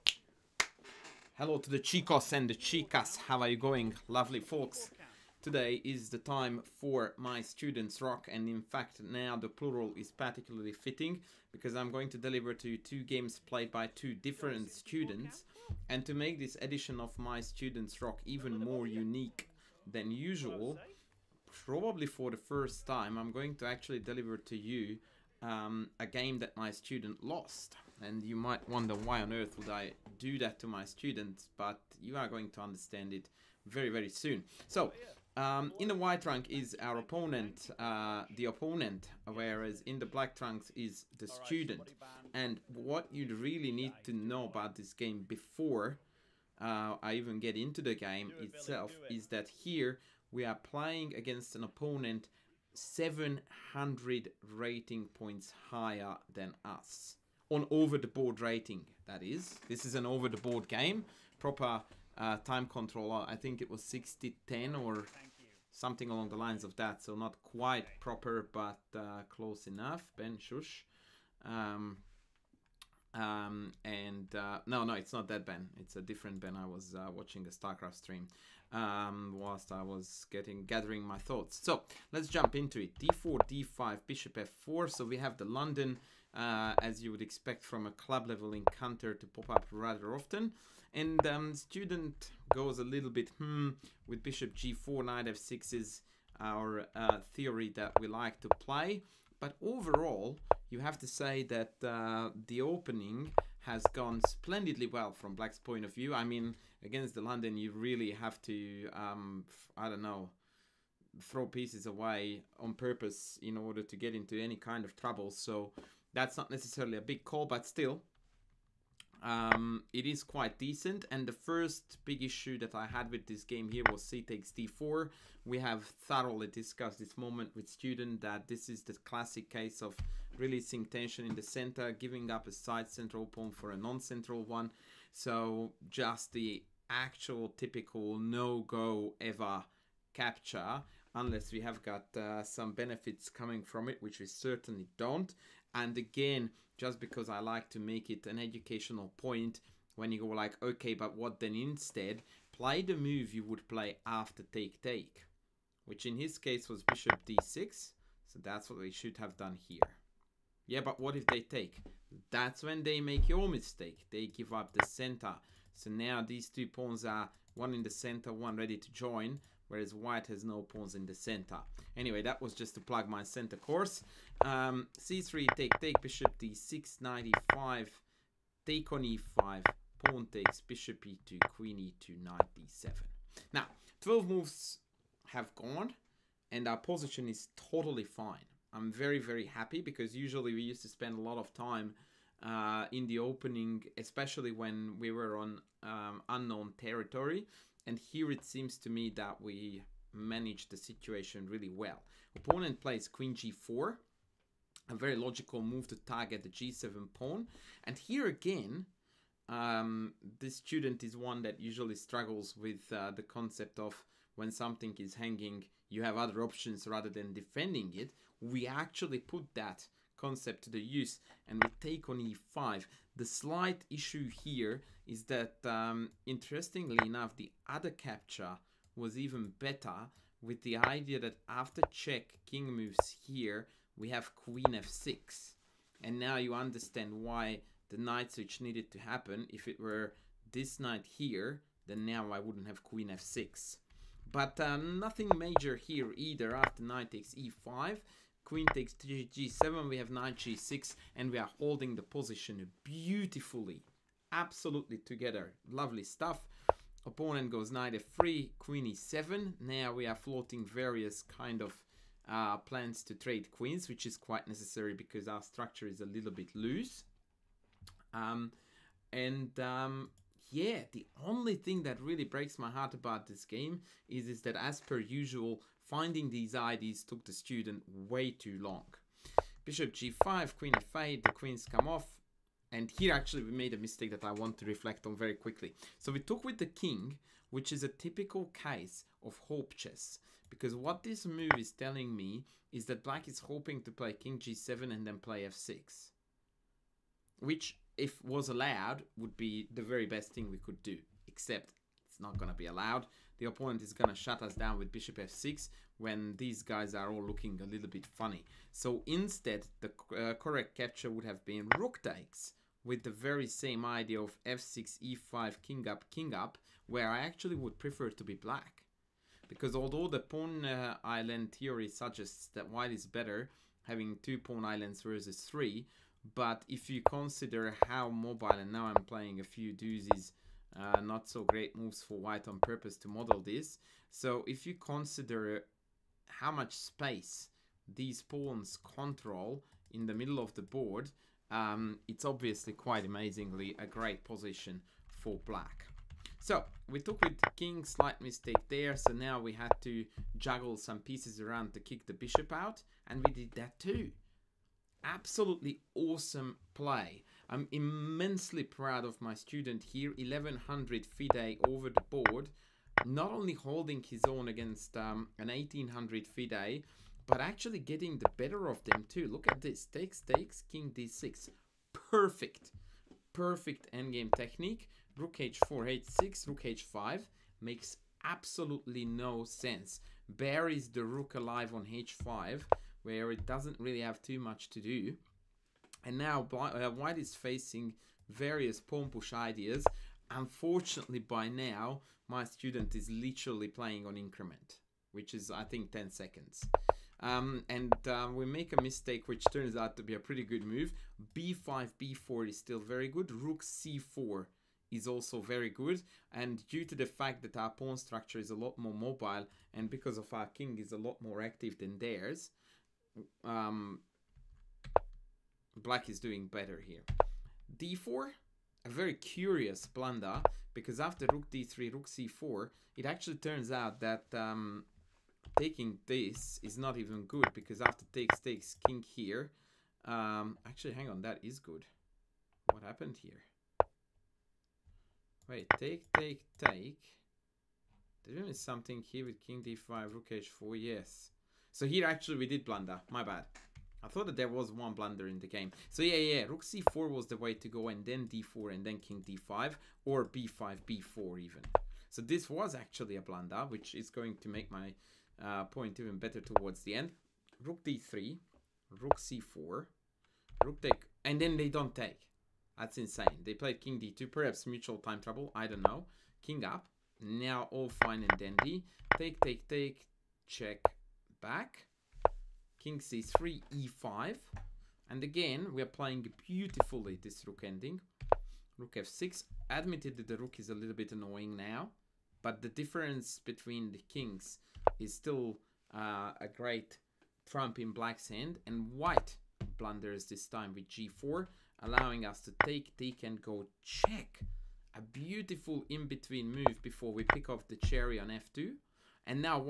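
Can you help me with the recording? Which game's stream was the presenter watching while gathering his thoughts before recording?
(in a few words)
StarCraft.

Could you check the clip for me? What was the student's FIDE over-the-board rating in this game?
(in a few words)
1100.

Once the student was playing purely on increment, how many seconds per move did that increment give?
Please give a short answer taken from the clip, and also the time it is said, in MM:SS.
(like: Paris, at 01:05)
10 seconds, at 06:35.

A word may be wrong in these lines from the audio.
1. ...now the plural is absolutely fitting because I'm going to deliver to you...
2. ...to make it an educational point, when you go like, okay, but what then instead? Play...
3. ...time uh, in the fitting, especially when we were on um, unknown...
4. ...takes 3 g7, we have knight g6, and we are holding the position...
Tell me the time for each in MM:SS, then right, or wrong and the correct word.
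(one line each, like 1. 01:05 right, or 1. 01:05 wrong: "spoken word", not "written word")
1. 00:09 wrong: "particularly", not "absolutely"
2. 02:27 right
3. 03:11 wrong: "opening", not "fitting"
4. 04:08 right.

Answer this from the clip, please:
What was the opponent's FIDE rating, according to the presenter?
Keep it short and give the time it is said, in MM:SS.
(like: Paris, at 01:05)
1800, at 06:05.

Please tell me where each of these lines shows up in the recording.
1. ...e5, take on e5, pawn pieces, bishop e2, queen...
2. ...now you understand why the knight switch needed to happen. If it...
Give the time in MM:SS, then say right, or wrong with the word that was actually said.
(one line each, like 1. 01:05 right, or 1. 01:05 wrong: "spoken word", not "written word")
1. 02:57 wrong: "takes", not "pieces"
2. 03:56 right.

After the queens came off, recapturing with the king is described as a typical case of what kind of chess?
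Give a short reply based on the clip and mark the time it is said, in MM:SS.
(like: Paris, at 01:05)
Hope chess, at 04:49.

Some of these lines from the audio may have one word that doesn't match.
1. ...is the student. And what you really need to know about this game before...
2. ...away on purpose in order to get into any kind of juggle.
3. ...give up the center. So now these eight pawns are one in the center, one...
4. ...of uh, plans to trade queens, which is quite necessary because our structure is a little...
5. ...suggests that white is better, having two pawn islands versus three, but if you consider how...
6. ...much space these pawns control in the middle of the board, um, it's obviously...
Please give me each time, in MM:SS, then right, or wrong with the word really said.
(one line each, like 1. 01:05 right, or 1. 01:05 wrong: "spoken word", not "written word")
1. 00:40 right
2. 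01:51 wrong: "trouble", not "juggle"
3. 02:44 wrong: "two", not "eight"
4. 04:21 right
5. 05:21 right
6. 05:36 right.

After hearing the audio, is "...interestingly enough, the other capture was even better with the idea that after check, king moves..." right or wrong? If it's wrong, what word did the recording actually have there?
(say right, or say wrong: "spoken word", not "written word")
right.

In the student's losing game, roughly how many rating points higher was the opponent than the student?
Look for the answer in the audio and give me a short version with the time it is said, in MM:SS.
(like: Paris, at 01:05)
700, at 00:52.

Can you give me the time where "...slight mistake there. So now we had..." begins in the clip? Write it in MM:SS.
05:47.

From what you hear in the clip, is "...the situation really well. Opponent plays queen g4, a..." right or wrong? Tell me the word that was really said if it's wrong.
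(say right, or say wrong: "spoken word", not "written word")
right.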